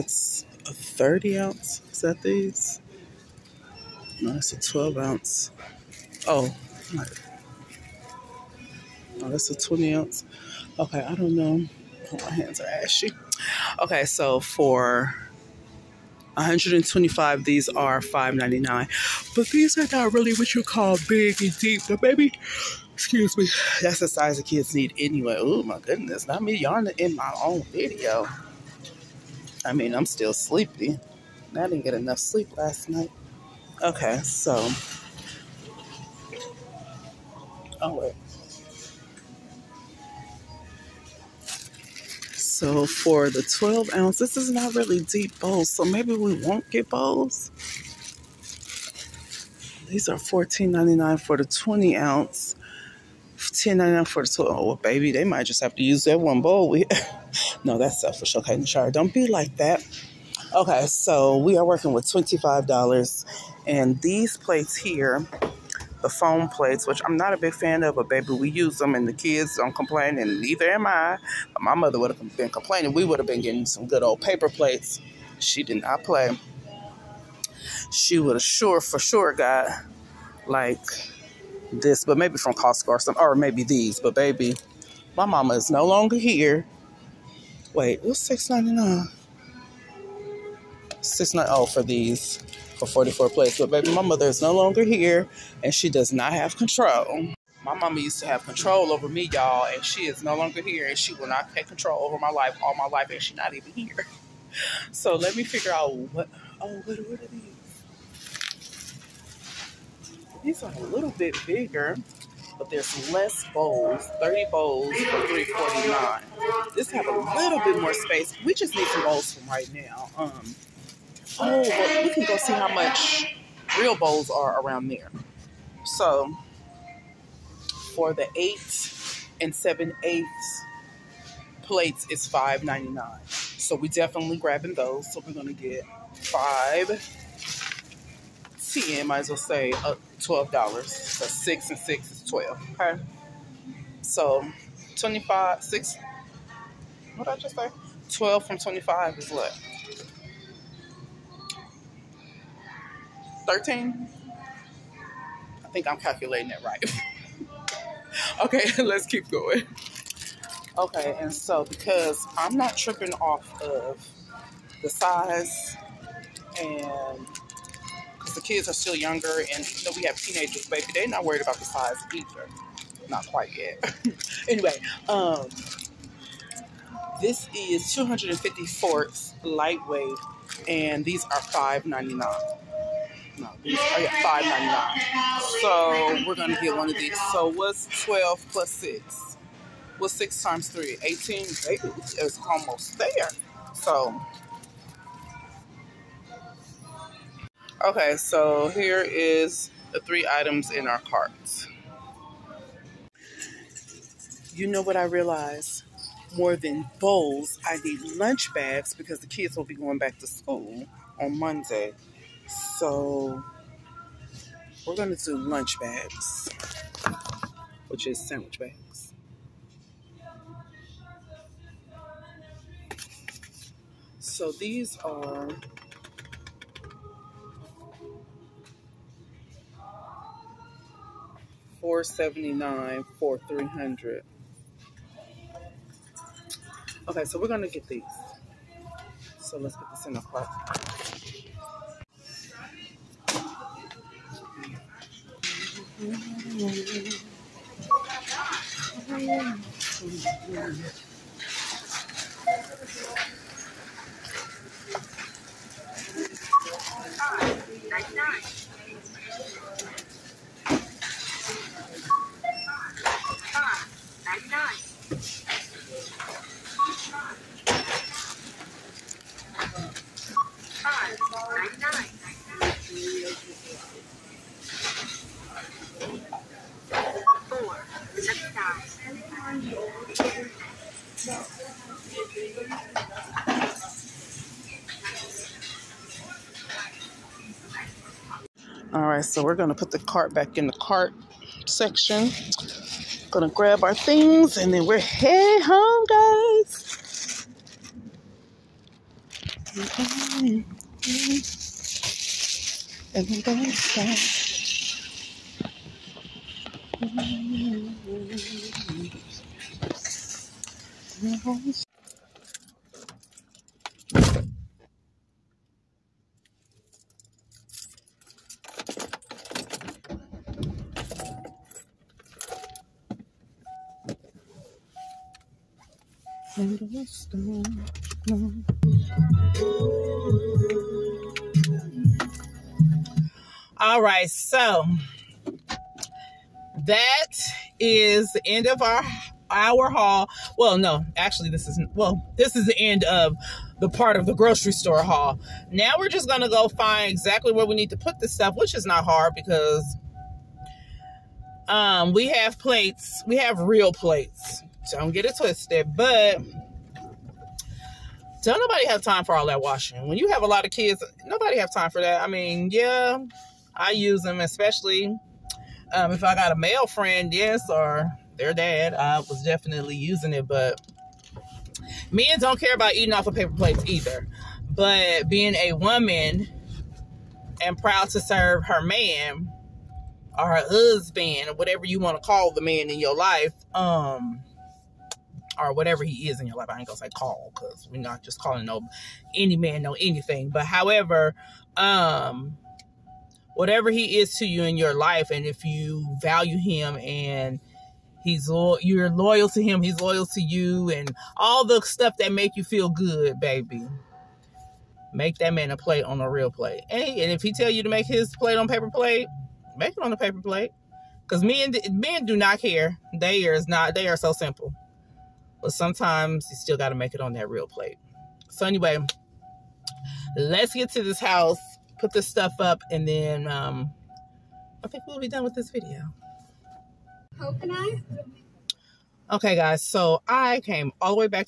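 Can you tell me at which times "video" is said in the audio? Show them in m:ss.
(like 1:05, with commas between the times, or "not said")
0:27, 7:05.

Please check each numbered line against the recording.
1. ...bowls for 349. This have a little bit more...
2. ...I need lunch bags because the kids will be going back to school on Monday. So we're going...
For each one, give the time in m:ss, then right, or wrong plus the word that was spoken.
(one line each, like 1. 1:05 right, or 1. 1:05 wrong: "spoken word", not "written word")
1. 1:54 right
2. 3:27 right.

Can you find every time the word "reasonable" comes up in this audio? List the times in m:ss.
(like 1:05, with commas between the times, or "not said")
not said.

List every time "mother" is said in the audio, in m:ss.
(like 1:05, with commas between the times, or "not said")
1:11, 1:34.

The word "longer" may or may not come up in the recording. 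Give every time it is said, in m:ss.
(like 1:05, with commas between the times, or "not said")
1:25, 1:34, 1:40.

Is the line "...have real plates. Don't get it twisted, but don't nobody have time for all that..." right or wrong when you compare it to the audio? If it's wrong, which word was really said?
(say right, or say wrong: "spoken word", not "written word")
right.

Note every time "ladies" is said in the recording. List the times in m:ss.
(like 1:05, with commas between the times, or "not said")
not said.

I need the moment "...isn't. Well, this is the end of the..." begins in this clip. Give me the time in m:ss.
5:41.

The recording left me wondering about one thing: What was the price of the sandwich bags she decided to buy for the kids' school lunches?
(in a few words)
$4.79.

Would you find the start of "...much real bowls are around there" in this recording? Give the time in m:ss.
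2:02.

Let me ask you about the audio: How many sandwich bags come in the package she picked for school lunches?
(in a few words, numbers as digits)
300.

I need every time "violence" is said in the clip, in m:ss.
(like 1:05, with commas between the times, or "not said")
not said.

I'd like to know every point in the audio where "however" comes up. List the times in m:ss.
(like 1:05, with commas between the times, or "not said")
6:30.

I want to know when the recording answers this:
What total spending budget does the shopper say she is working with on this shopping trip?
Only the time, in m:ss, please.
1:02.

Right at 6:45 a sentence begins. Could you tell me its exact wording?
Make that man a plate on a real plate.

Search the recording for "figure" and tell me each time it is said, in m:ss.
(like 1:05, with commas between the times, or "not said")
1:45.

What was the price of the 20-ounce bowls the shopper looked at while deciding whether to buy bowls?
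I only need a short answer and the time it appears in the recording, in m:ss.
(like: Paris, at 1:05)
$14.99, at 0:50.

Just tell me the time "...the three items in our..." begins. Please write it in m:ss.
3:19.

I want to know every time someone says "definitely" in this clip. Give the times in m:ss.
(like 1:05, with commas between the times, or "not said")
2:13, 6:09.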